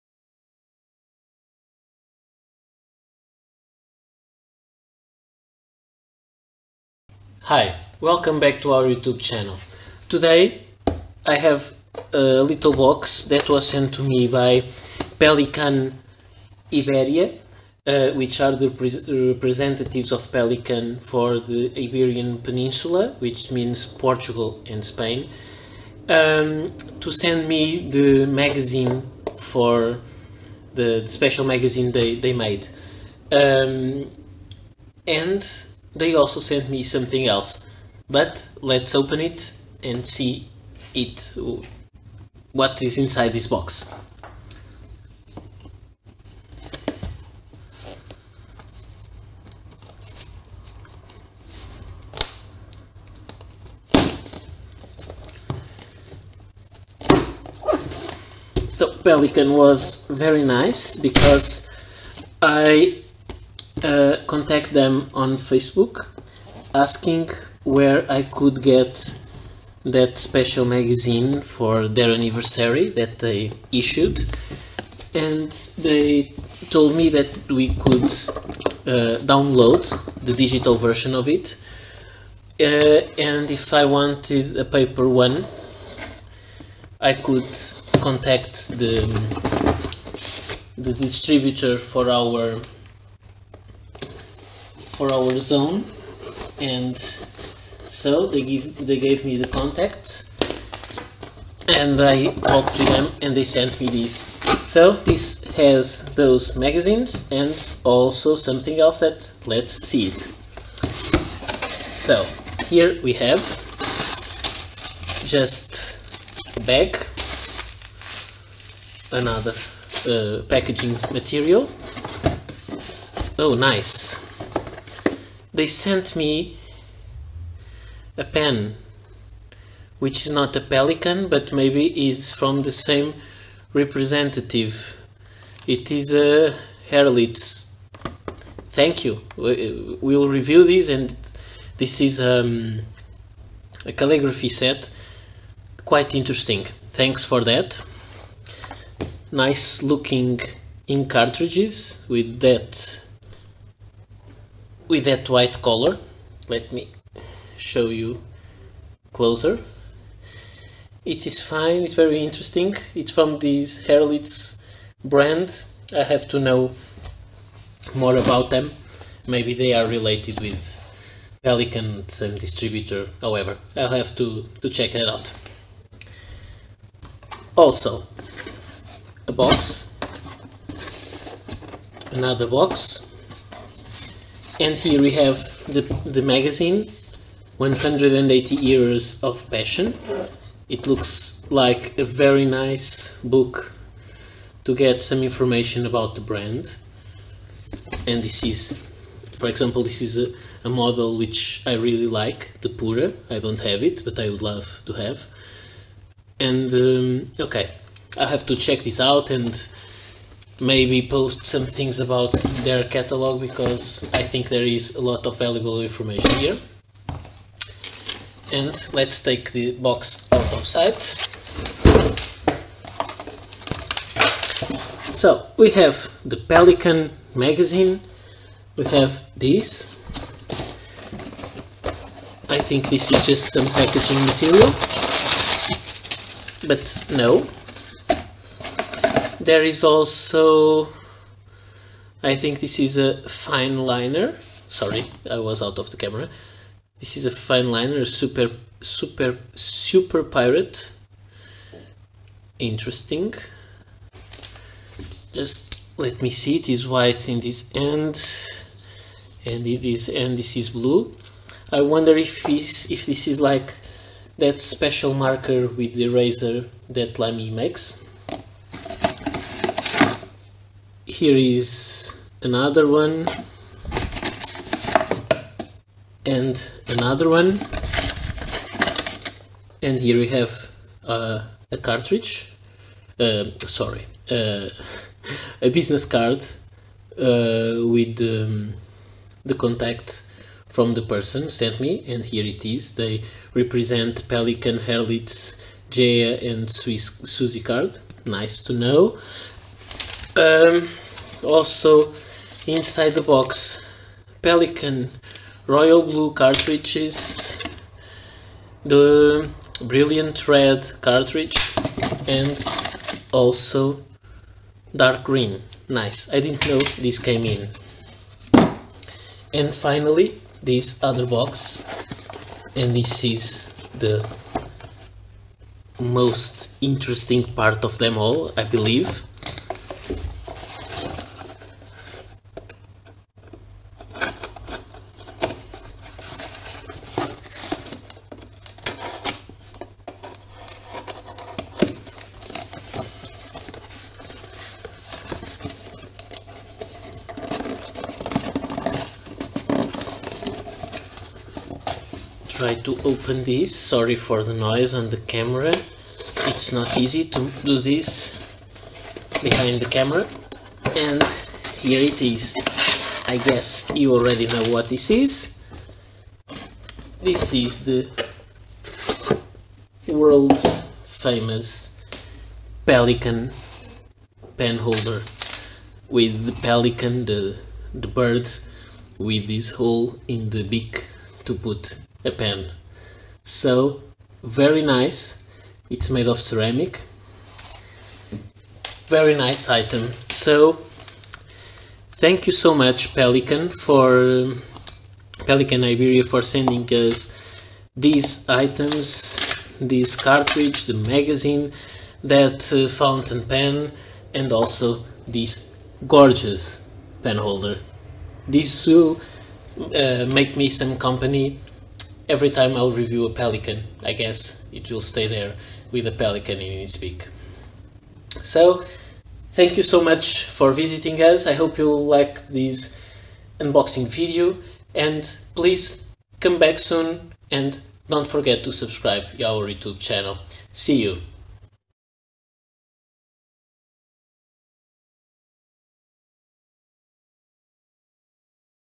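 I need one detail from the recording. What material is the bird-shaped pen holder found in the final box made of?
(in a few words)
Ceramic.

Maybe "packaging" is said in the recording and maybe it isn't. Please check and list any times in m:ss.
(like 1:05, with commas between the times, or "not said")
2:00, 3:53.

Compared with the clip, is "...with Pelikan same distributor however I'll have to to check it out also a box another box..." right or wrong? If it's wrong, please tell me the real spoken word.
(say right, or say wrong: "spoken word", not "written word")
right.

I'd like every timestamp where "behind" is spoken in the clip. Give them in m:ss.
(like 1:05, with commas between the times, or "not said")
5:59.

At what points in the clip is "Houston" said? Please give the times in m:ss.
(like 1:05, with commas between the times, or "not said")
not said.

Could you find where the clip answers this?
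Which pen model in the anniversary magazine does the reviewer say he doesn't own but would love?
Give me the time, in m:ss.
3:22.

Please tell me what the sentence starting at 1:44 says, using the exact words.
So this has those magazines and also something else that let's see it.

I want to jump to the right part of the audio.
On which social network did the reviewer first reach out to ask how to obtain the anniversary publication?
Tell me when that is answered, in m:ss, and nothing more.
1:05.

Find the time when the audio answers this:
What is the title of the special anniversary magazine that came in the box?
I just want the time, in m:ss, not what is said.
3:07.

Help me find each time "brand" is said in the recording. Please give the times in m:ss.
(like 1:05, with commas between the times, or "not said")
2:45, 3:16.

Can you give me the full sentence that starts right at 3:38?
And let's take the box out of sight.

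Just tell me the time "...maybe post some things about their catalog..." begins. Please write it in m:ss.
3:30.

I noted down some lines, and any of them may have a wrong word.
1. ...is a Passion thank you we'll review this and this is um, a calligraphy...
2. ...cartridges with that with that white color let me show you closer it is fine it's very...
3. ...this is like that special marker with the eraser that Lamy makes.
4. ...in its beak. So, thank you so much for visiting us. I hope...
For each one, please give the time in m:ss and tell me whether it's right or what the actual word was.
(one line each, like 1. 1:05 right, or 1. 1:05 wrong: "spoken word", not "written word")
1. 2:15 wrong: "Herlitz", not "Passion"
2. 2:31 right
3. 4:23 right
4. 6:56 right.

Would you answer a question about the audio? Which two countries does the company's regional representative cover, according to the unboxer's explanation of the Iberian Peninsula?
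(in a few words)
Portugal and Spain.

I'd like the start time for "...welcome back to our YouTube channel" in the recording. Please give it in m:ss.
0:07.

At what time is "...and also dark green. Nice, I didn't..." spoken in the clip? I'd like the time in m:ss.
5:12.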